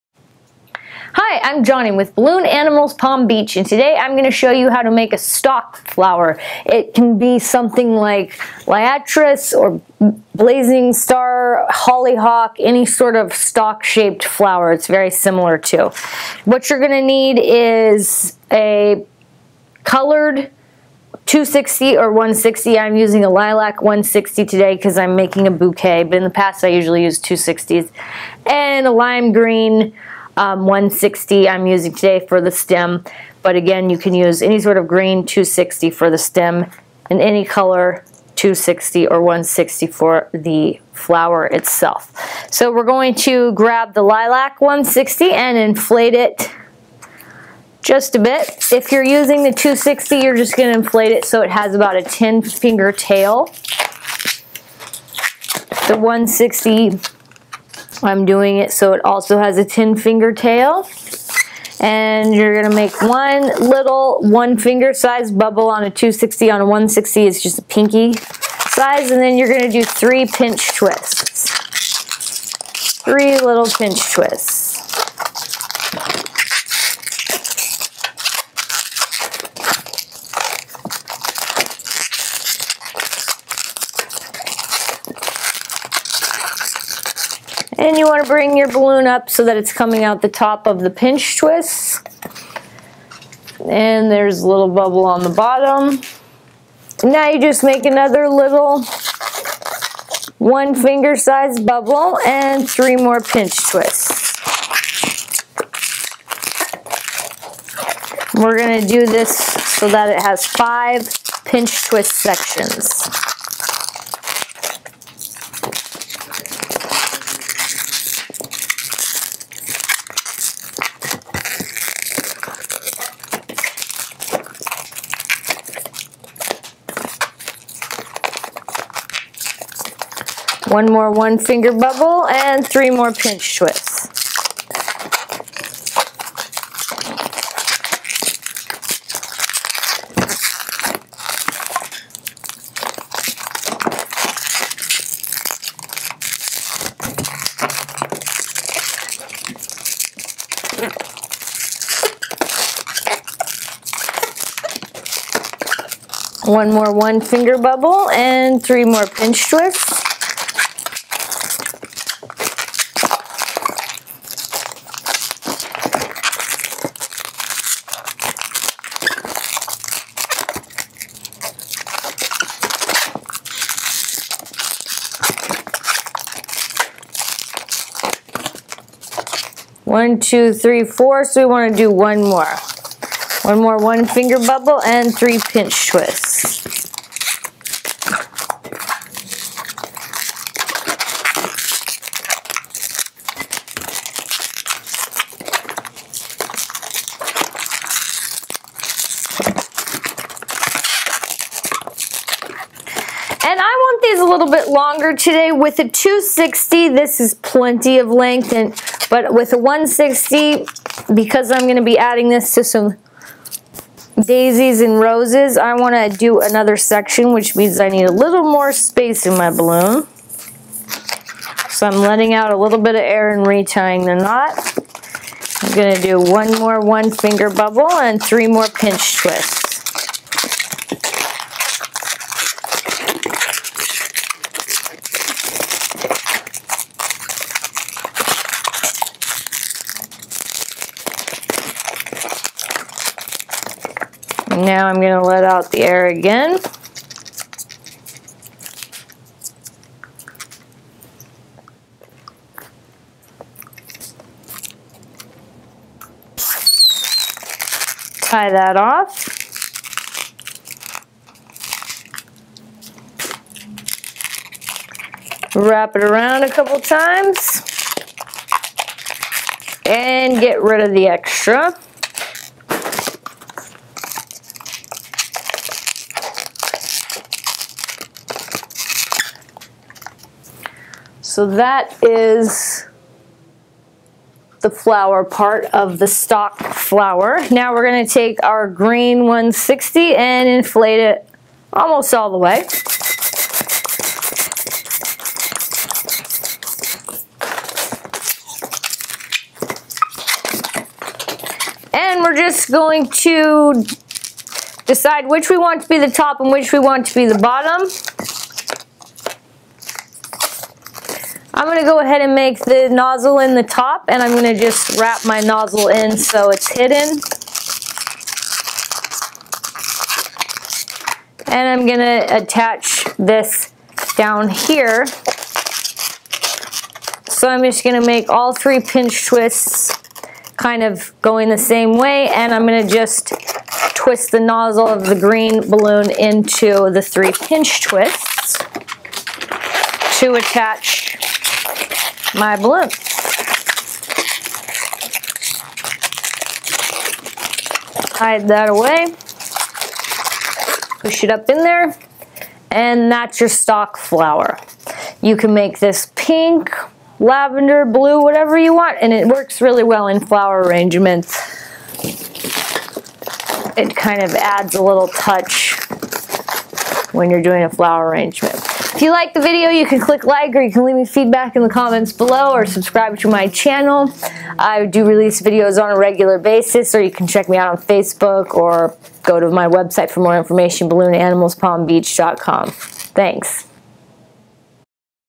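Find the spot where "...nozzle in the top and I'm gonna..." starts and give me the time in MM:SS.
05:12.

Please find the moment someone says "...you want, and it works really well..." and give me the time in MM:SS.
05:58.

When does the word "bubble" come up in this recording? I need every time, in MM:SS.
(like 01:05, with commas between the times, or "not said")
01:05, 01:34, 01:41, 02:11, 02:37, 03:04, 03:47.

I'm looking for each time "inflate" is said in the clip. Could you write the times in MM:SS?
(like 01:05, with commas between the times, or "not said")
00:45, 00:50, 04:50.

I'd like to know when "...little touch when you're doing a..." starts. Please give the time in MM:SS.
06:04.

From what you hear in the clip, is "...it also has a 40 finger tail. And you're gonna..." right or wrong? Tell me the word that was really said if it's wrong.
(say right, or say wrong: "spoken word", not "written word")
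wrong: "10", not "40".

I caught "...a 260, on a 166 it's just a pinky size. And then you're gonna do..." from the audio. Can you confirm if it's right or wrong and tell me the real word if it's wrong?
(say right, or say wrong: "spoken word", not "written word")
wrong: "160", not "166".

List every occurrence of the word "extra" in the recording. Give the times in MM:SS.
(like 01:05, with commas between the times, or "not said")
04:31.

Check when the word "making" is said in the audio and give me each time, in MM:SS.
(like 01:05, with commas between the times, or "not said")
00:25.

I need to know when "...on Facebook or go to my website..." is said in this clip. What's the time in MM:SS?
06:17.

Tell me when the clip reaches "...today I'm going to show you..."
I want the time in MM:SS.
00:03.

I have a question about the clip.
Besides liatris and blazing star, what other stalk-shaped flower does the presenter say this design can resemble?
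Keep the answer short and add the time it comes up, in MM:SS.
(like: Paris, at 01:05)
Hollyhock, at 00:11.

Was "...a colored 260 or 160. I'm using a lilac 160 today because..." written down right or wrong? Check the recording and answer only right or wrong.
right.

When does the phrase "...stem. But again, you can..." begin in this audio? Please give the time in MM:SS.
00:32.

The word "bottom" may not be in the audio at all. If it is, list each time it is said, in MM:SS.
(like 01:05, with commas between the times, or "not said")
01:35, 05:07.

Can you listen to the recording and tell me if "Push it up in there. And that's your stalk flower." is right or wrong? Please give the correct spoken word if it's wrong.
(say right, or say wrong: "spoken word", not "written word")
right.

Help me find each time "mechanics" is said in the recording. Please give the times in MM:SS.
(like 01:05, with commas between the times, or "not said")
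not said.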